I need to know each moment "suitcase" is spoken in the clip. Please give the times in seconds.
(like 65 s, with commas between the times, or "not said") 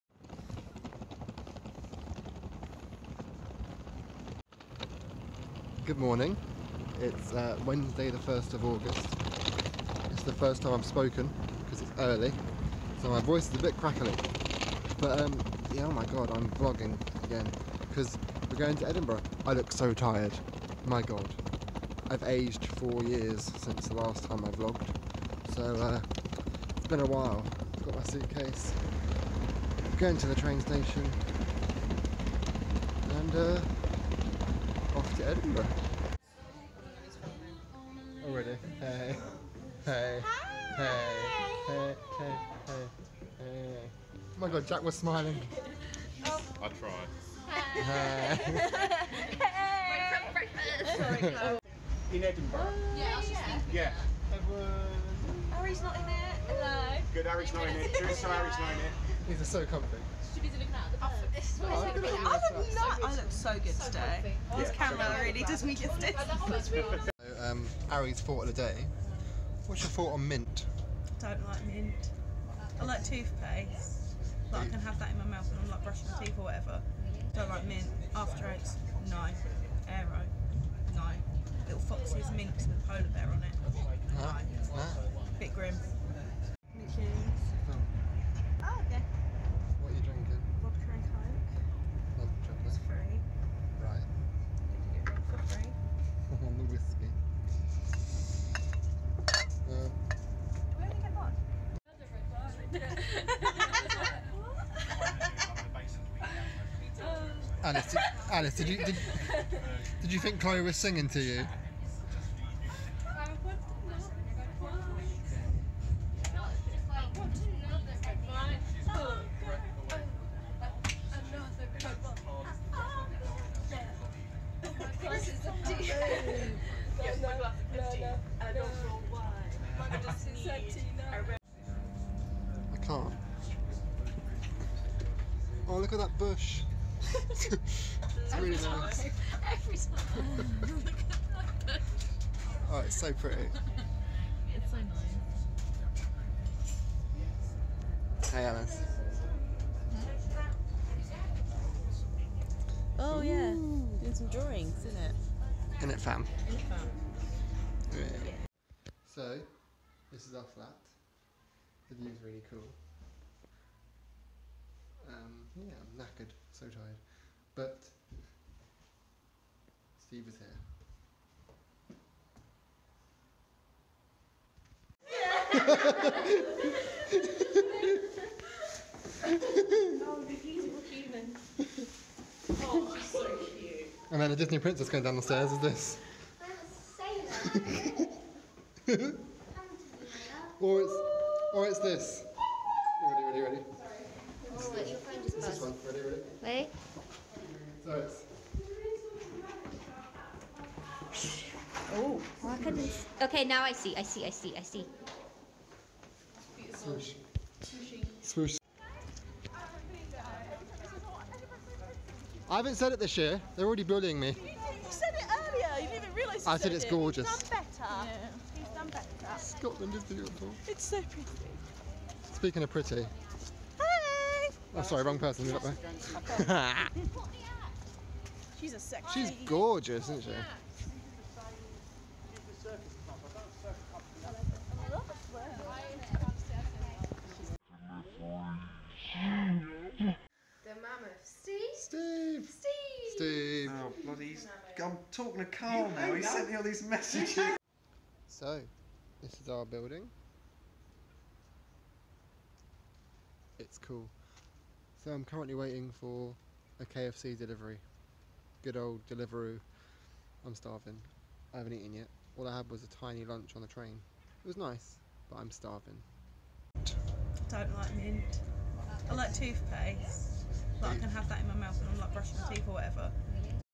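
28 s.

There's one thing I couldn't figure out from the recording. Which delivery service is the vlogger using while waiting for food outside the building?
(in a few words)
Deliveroo.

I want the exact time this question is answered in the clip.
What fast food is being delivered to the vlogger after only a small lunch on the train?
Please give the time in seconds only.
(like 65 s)
256 s.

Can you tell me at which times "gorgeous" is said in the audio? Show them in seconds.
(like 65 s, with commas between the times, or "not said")
216 s, 229 s.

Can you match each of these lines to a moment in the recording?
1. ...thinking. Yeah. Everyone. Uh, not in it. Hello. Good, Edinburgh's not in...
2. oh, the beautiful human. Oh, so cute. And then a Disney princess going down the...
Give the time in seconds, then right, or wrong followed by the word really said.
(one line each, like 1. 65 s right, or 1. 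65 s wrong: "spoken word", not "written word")
1. 53 s wrong: "Ari", not "Edinburgh"
2. 179 s right.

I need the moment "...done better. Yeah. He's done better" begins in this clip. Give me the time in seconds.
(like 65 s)
217 s.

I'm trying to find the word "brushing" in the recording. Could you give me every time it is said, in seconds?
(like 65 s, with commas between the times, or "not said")
75 s, 272 s.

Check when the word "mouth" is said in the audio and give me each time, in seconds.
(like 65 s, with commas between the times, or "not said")
75 s, 271 s.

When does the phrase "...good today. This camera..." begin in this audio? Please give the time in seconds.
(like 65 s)
63 s.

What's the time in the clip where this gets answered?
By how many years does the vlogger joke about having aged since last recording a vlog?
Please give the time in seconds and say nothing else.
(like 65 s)
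22 s.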